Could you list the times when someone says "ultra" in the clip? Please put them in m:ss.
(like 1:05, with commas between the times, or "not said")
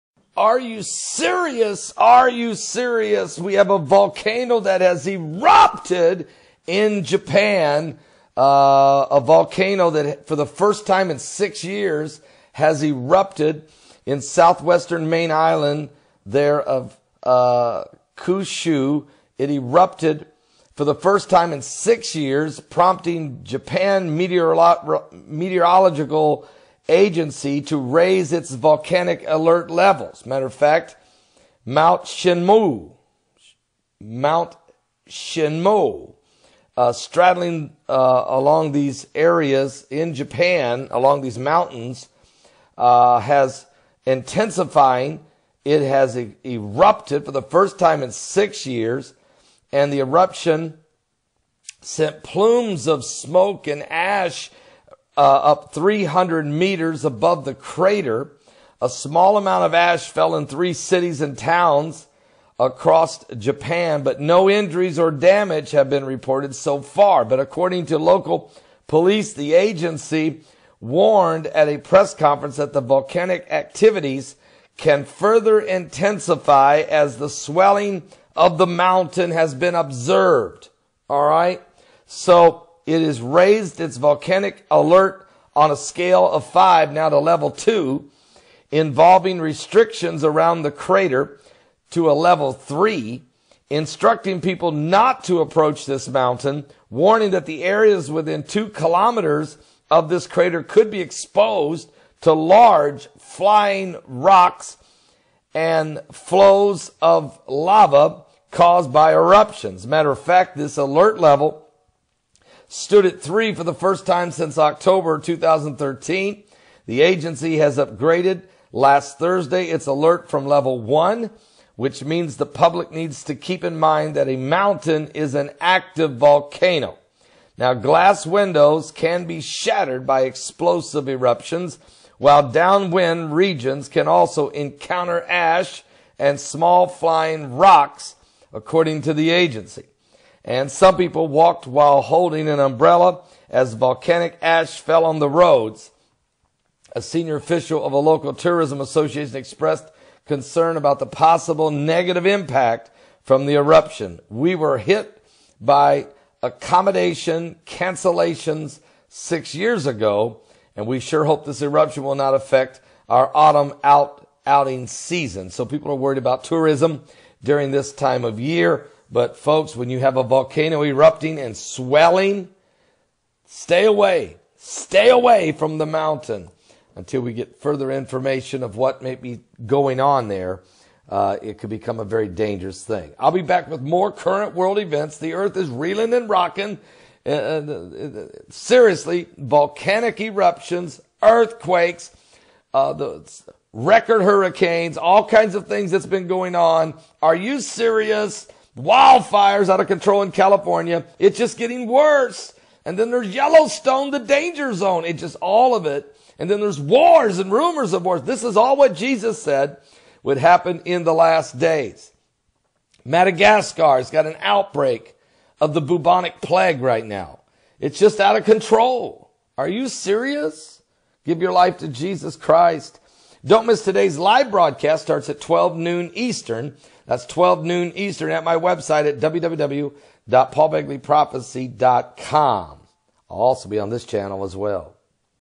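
not said.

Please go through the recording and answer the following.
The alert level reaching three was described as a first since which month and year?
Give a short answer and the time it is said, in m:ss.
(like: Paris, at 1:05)
October 2013, at 1:54.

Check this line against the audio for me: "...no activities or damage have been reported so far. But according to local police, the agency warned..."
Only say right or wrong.
wrong.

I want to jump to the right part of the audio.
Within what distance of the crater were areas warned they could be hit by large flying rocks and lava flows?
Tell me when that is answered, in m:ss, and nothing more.
1:38.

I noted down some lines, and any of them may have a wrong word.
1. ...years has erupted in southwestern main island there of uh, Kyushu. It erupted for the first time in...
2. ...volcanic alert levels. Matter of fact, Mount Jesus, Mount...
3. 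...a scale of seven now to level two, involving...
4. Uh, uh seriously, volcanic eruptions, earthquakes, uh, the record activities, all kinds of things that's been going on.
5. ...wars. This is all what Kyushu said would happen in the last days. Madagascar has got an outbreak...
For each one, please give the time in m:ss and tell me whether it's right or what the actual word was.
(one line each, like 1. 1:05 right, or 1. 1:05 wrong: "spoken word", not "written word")
1. 0:11 right
2. 0:28 wrong: "Shinmoe", not "Jesus"
3. 1:25 wrong: "five", not "seven"
4. 3:07 wrong: "hurricanes", not "activities"
5. 3:28 wrong: "Jesus", not "Kyushu".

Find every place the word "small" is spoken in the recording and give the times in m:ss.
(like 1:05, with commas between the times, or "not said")
0:58, 2:16.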